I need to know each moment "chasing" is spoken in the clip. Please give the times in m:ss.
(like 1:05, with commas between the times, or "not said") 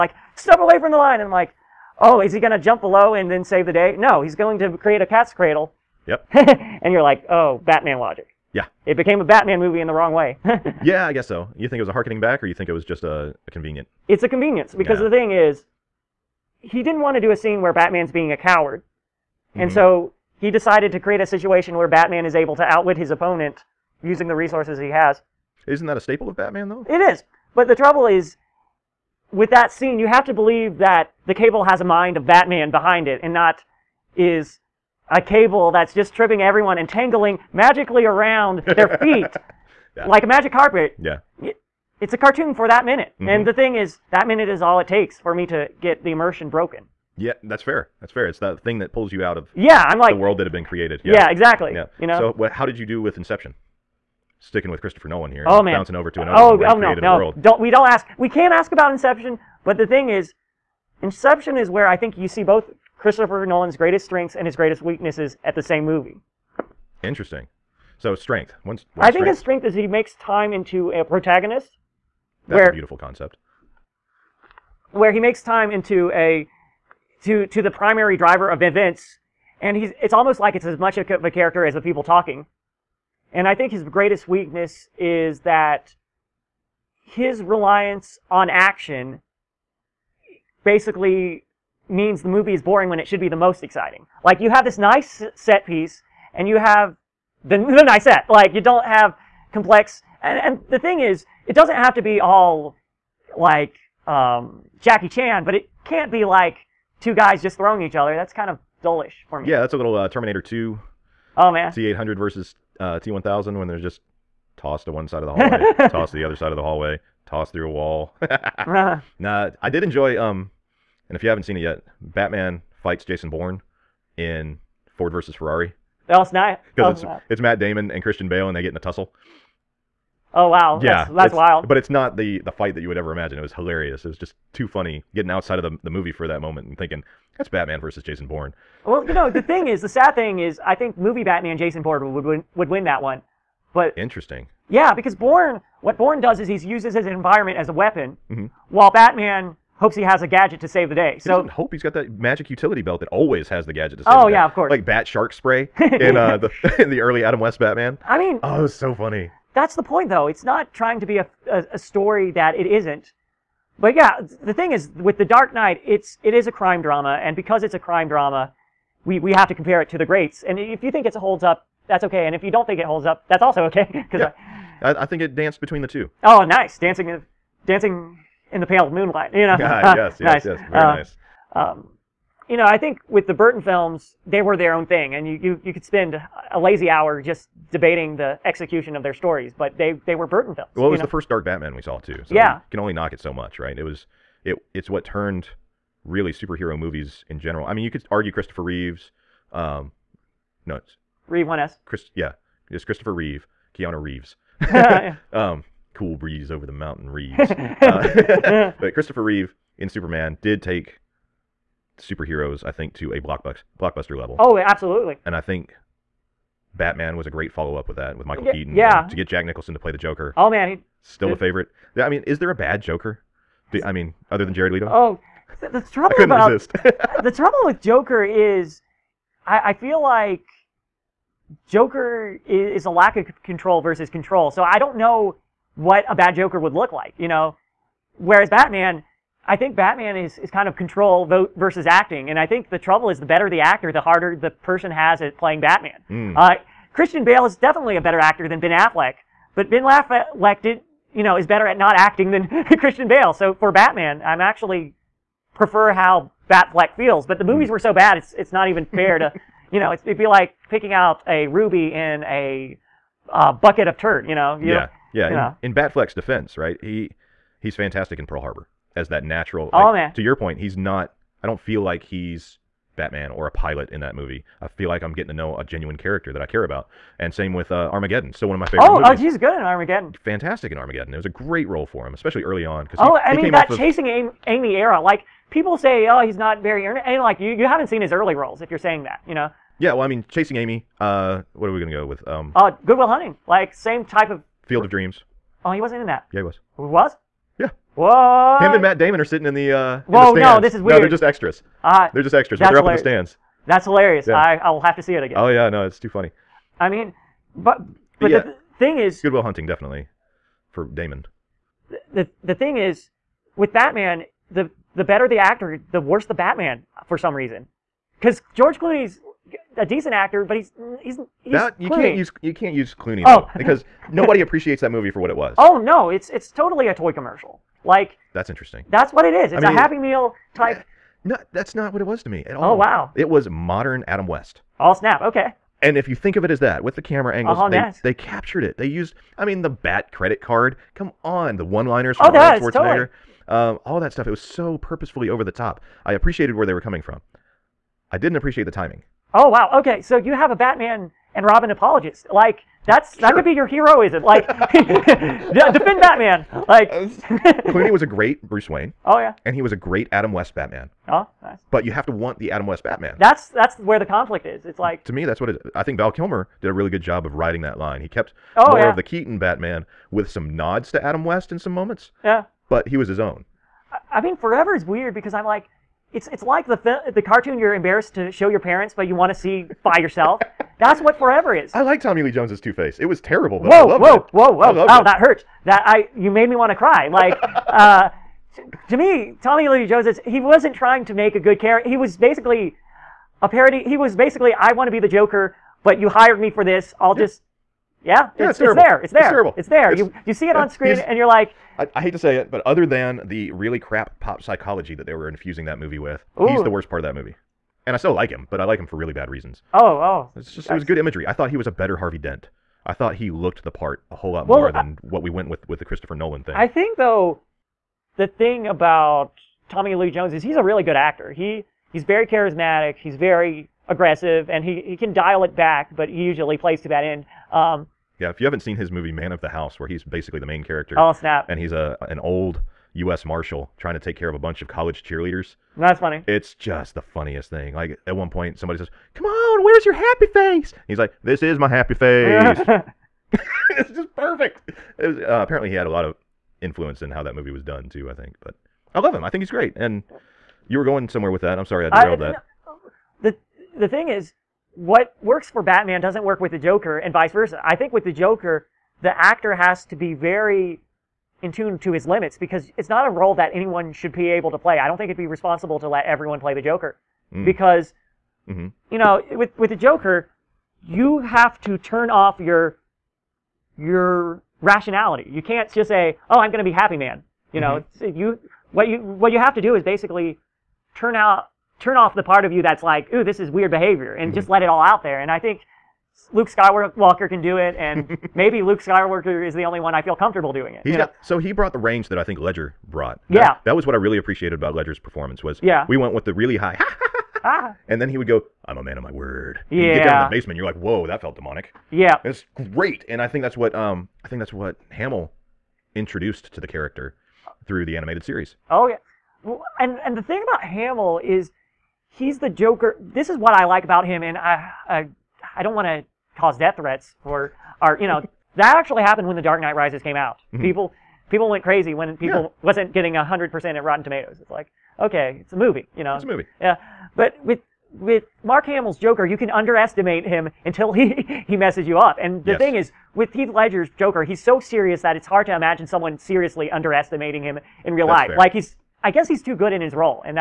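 4:43, 4:50.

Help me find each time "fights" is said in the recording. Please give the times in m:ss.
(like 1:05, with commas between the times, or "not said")
2:02, 2:12.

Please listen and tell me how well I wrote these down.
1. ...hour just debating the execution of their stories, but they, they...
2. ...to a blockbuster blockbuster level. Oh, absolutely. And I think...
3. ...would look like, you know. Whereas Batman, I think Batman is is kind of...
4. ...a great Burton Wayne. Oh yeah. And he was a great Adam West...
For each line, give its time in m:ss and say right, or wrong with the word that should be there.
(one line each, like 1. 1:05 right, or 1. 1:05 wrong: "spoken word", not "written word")
1. 3:06 right
2. 3:32 right
3. 3:56 right
4. 5:58 wrong: "Bruce", not "Burton".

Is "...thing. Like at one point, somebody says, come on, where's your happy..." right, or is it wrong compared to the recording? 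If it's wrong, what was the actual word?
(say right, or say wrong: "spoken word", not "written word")
right.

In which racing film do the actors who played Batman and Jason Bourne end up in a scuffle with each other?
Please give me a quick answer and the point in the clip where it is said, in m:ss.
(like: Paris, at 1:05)
Ford versus Ferrari, at 2:04.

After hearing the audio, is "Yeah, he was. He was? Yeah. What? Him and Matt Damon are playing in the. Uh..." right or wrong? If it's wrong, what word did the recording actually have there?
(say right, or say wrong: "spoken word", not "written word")
wrong: "sitting", not "playing".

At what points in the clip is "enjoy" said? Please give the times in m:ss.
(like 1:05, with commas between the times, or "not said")
1:59.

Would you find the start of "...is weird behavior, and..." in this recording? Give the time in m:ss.
8:03.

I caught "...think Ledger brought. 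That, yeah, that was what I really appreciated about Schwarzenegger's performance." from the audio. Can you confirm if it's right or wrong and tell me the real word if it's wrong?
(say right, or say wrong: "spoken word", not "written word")
wrong: "Ledger", not "Schwarzenegger".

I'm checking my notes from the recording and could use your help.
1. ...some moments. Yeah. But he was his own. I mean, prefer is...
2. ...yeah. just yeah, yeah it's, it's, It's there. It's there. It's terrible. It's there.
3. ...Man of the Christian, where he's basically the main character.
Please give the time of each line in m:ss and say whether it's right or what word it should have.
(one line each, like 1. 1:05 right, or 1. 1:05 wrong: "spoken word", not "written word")
1. 6:11 wrong: "forever", not "prefer"
2. 6:37 right
3. 7:09 wrong: "House", not "Christian".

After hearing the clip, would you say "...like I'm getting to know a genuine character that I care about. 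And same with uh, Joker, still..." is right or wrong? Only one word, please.
wrong.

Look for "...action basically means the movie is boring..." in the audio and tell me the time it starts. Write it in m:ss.
1:28.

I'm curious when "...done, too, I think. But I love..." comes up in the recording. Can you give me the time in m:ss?
7:27.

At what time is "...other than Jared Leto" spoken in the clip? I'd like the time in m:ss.
3:44.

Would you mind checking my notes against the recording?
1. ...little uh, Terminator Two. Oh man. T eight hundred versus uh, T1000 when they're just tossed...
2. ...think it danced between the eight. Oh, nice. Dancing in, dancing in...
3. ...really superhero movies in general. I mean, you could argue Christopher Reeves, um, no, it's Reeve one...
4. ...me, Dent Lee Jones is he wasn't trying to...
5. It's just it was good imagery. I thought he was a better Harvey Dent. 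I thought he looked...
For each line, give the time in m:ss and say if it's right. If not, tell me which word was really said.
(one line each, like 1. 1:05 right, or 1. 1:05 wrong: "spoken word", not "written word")
1. 1:49 right
2. 2:55 wrong: "two", not "eight"
3. 3:16 right
4. 6:28 wrong: "Tommy", not "Dent"
5. 6:50 right.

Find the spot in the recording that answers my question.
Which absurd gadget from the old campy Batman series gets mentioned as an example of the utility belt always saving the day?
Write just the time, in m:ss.
2:34.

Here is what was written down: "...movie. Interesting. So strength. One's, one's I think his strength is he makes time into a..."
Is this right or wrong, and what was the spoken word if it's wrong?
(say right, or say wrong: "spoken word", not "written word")
right.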